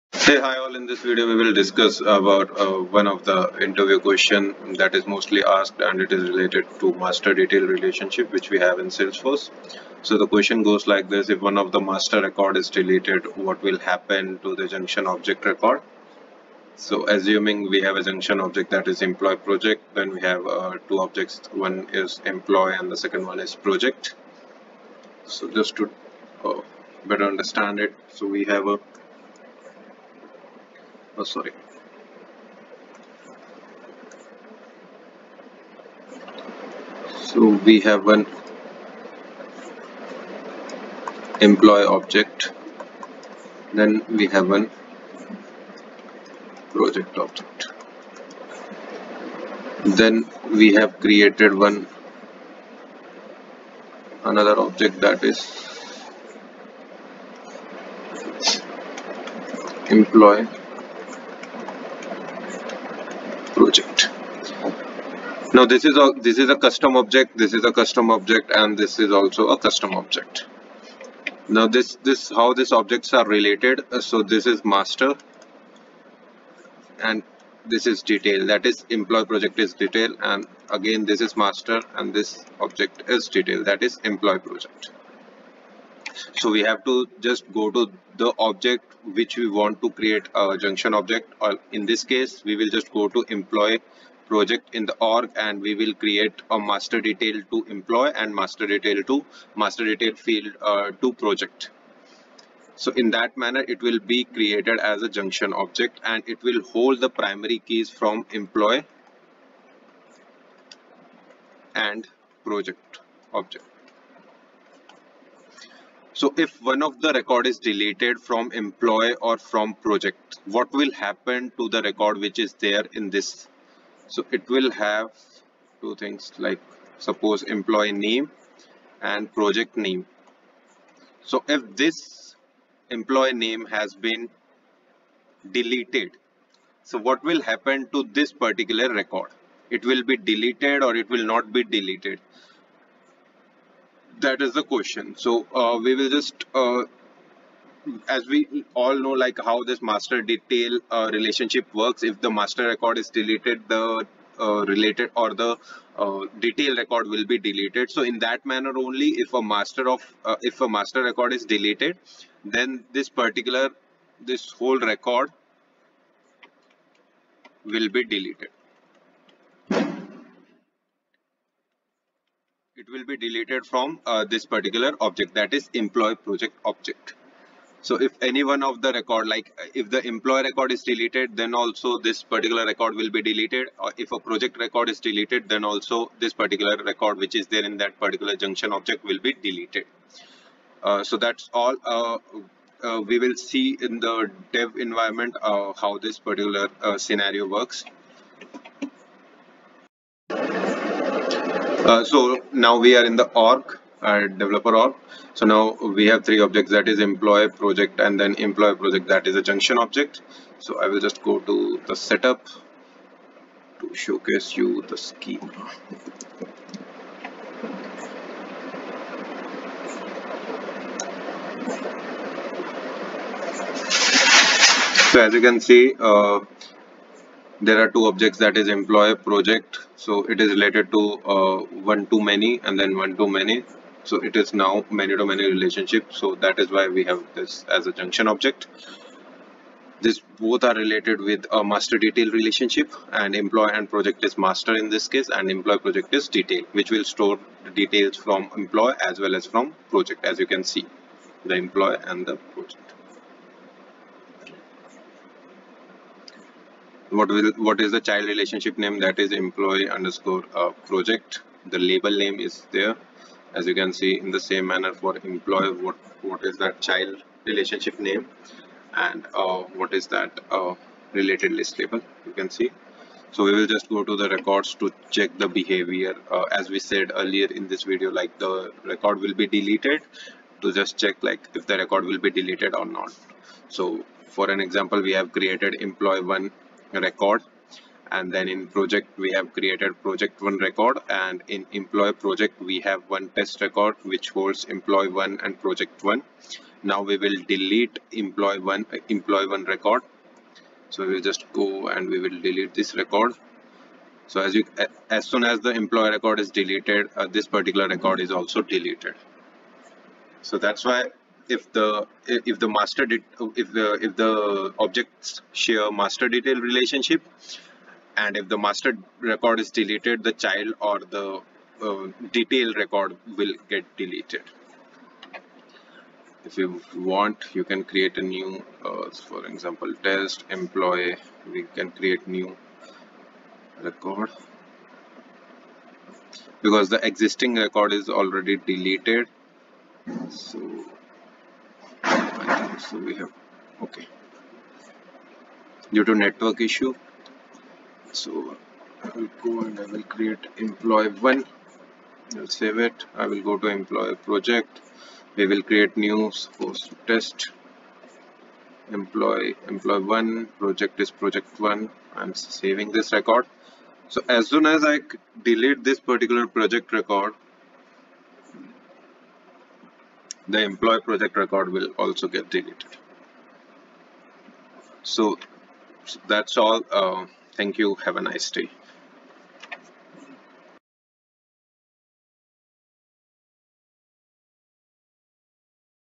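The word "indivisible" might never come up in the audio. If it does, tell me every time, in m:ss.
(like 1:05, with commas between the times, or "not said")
not said.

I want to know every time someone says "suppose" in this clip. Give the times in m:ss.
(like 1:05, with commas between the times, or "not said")
2:06, 5:56.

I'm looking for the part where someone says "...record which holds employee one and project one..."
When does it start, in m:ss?
4:53.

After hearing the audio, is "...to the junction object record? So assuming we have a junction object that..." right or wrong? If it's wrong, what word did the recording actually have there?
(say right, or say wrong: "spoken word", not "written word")
right.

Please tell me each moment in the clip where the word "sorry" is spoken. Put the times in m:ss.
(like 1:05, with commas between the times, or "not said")
0:31.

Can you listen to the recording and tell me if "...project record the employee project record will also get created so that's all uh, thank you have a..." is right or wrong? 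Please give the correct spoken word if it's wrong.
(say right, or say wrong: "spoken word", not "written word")
wrong: "deleted", not "created".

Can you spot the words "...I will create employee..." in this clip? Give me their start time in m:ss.
5:49.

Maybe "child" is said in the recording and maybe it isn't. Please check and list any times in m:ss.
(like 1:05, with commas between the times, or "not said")
4:17, 4:26, 5:20.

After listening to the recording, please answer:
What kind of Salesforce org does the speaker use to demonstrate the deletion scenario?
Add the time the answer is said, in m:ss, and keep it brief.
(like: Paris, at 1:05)
developer org, at 3:24.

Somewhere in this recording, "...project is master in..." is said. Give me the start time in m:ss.
4:03.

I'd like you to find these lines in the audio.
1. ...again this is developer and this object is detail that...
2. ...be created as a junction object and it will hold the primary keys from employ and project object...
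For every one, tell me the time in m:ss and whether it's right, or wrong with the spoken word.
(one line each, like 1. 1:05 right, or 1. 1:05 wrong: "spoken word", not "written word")
1. 1:20 wrong: "master", not "developer"
2. 1:43 right.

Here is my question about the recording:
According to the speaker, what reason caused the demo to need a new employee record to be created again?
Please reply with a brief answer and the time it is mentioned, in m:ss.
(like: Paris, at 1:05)
network issue, at 5:46.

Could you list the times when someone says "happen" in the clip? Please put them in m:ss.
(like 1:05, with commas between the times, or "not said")
0:13, 2:00, 2:17.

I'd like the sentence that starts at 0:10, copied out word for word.
So the question goes like this.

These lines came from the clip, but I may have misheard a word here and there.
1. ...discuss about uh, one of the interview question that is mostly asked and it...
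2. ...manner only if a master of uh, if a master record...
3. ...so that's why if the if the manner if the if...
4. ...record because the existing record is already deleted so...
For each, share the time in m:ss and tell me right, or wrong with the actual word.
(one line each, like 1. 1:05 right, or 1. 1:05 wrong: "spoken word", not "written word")
1. 0:01 right
2. 2:38 right
3. 5:10 wrong: "master", not "manner"
4. 5:33 right.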